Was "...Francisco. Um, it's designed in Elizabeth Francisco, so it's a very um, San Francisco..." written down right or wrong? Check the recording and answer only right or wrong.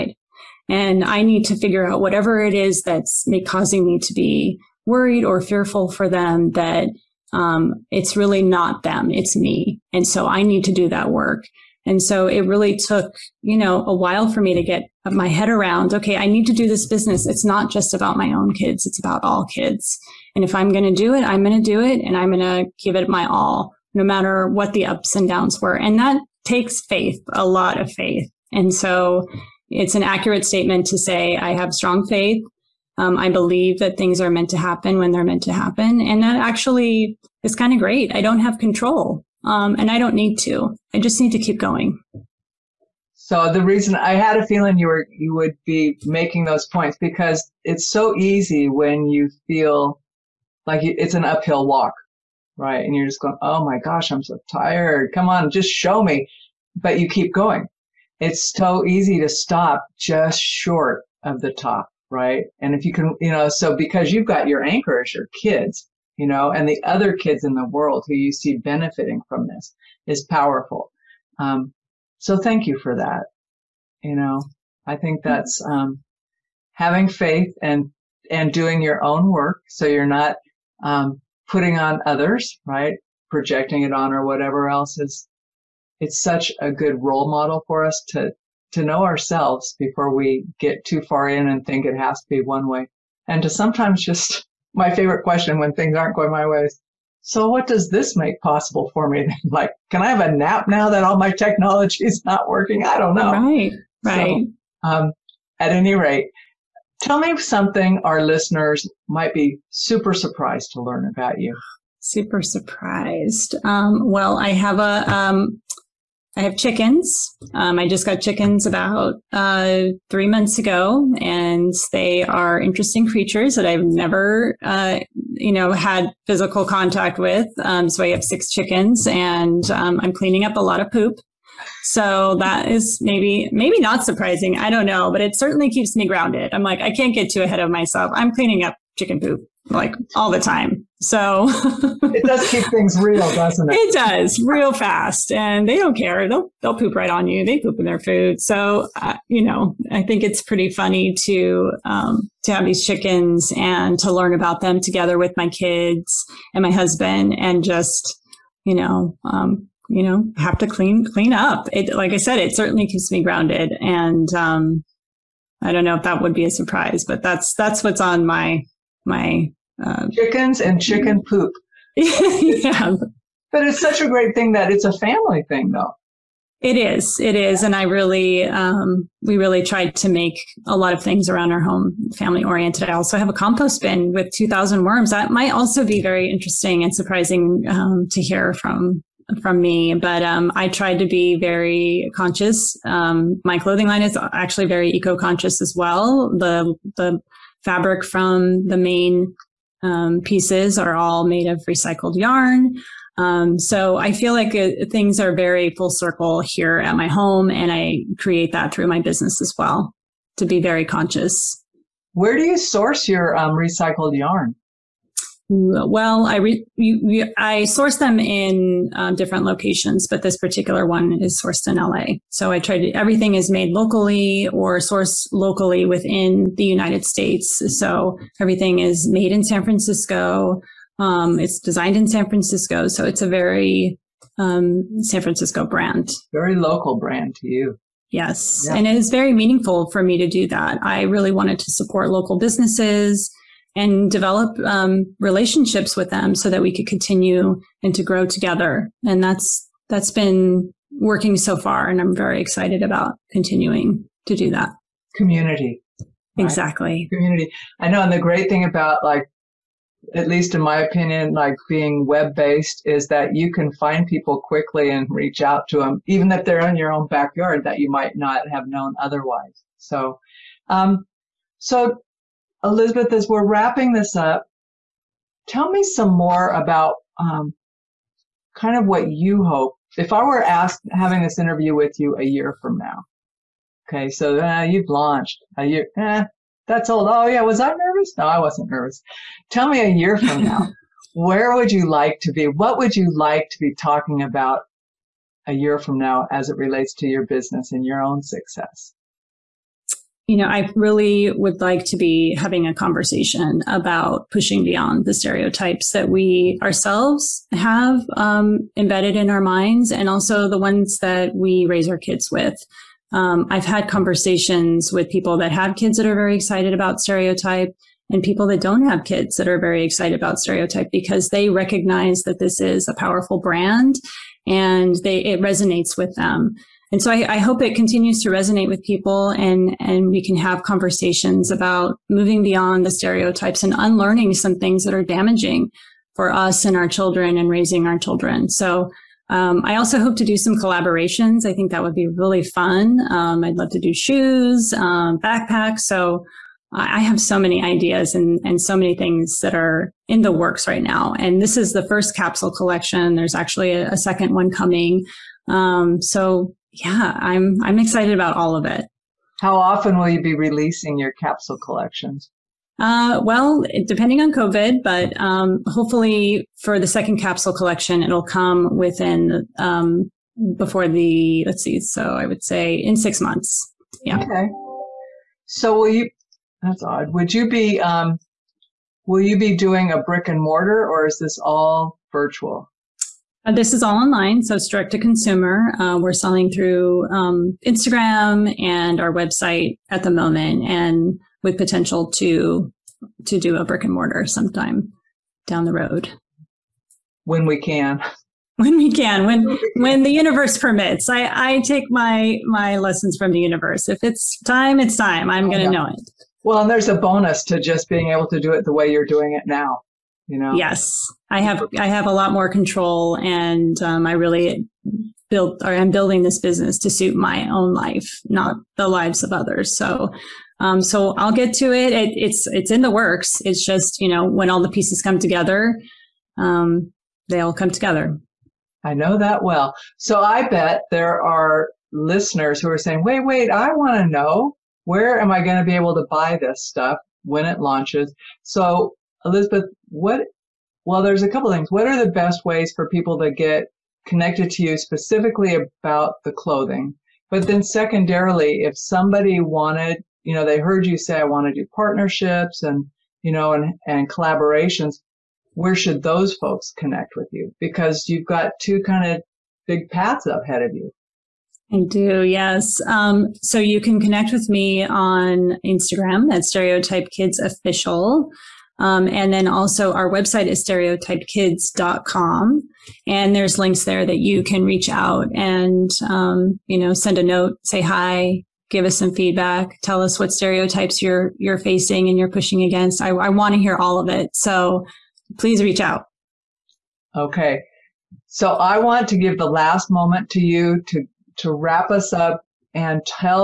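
wrong.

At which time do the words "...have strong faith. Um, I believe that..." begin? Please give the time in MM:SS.
00:31.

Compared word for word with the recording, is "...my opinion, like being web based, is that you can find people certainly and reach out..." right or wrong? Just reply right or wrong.
wrong.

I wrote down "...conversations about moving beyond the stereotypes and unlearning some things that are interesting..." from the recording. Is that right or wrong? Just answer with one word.
wrong.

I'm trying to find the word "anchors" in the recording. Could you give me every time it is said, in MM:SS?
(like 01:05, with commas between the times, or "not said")
01:04.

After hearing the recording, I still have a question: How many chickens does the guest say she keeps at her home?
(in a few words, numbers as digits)
6.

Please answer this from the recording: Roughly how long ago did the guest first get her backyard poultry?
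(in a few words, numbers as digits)
three months.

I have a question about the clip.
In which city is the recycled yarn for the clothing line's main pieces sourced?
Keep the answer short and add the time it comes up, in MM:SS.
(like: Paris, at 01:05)
LA, at 03:41.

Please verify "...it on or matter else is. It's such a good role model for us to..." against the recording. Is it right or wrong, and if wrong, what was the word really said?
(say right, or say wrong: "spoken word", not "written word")
wrong: "whatever", not "matter".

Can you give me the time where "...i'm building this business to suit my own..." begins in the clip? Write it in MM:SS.
06:55.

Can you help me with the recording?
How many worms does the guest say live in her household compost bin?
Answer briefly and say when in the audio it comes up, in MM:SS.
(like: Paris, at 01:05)
2000, at 03:04.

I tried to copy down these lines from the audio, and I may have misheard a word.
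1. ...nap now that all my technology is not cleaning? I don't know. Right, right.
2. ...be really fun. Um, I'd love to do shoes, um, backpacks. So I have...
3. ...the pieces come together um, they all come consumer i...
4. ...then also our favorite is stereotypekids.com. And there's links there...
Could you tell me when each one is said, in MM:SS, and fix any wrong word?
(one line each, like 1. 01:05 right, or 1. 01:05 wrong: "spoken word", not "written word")
1. 01:40 wrong: "working", not "cleaning"
2. 05:41 right
3. 07:04 wrong: "together", not "consumer"
4. 07:49 wrong: "website", not "favorite".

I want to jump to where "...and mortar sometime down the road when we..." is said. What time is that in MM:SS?
06:33.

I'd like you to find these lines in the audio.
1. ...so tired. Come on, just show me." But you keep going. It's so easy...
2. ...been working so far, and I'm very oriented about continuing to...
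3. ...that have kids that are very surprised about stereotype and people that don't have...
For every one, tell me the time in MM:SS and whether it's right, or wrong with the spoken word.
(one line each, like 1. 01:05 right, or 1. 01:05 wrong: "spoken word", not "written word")
1. 00:54 right
2. 04:10 wrong: "excited", not "oriented"
3. 05:15 wrong: "excited", not "surprised".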